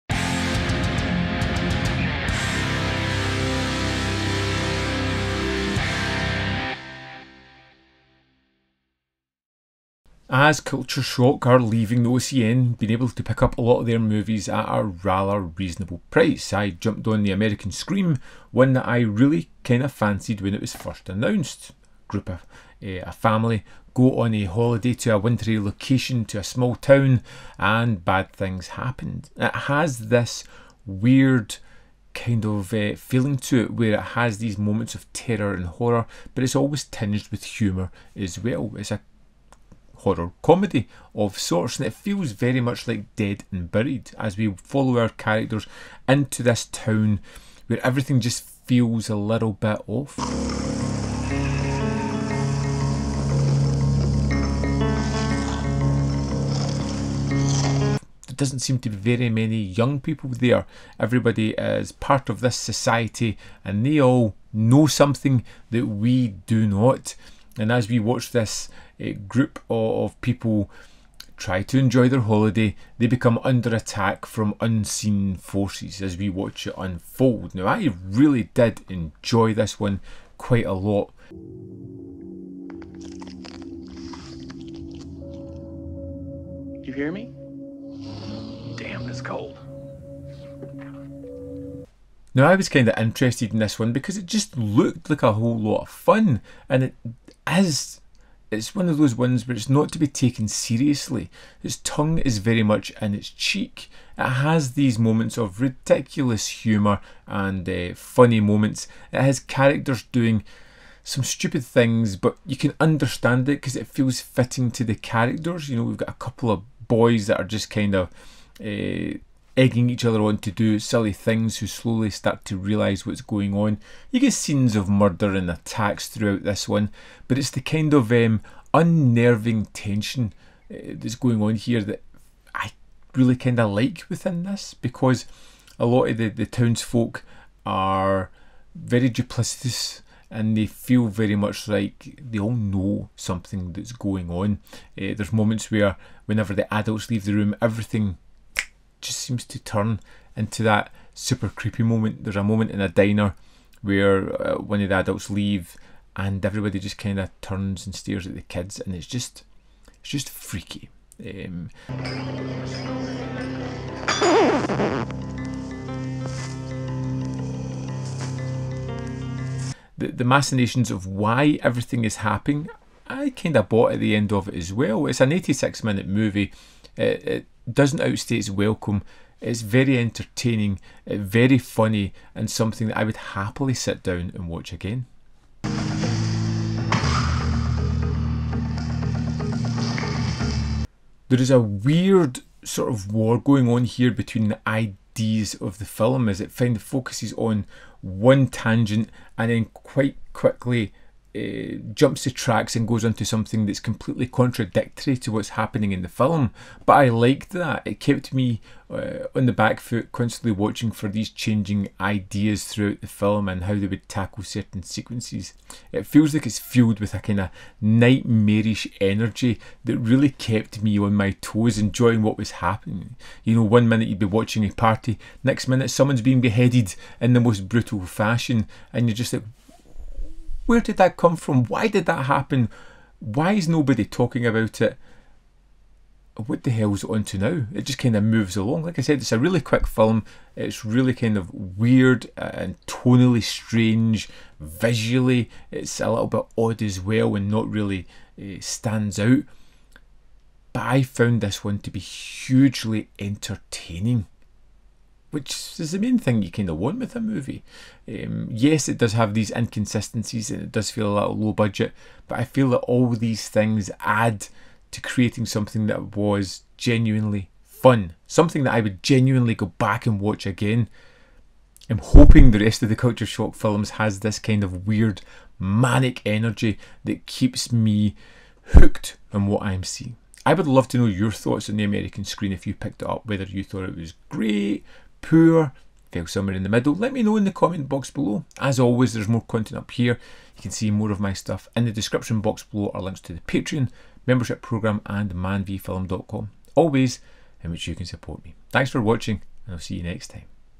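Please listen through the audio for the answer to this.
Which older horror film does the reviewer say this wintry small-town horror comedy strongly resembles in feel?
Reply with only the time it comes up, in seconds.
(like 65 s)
43 s.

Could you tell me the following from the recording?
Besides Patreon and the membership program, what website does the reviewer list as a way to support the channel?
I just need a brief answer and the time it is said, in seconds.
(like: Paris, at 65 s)
manvfilm.com, at 295 s.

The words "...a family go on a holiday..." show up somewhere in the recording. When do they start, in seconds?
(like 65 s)
23 s.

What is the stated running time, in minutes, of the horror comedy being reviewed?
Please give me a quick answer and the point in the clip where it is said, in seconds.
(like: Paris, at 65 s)
86, at 175 s.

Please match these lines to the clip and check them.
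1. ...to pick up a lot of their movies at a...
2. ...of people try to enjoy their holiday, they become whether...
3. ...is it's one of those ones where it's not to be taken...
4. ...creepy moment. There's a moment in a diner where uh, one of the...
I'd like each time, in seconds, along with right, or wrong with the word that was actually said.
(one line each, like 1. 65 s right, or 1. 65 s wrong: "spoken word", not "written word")
1. 13 s right
2. 70 s wrong: "under", not "whether"
3. 97 s right
4. 151 s right.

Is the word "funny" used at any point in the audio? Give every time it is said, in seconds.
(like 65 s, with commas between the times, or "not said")
107 s, 181 s.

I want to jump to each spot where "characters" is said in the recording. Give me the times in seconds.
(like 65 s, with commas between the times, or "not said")
45 s, 109 s, 114 s.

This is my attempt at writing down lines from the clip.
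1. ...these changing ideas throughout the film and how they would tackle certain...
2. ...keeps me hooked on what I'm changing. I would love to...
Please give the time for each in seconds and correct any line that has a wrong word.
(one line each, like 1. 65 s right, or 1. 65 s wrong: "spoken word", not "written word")
1. 211 s right
2. 277 s wrong: "seeing", not "changing".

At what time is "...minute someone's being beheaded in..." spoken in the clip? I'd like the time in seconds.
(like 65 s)
225 s.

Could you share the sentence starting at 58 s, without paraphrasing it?
doesn't seem to be very many young people there.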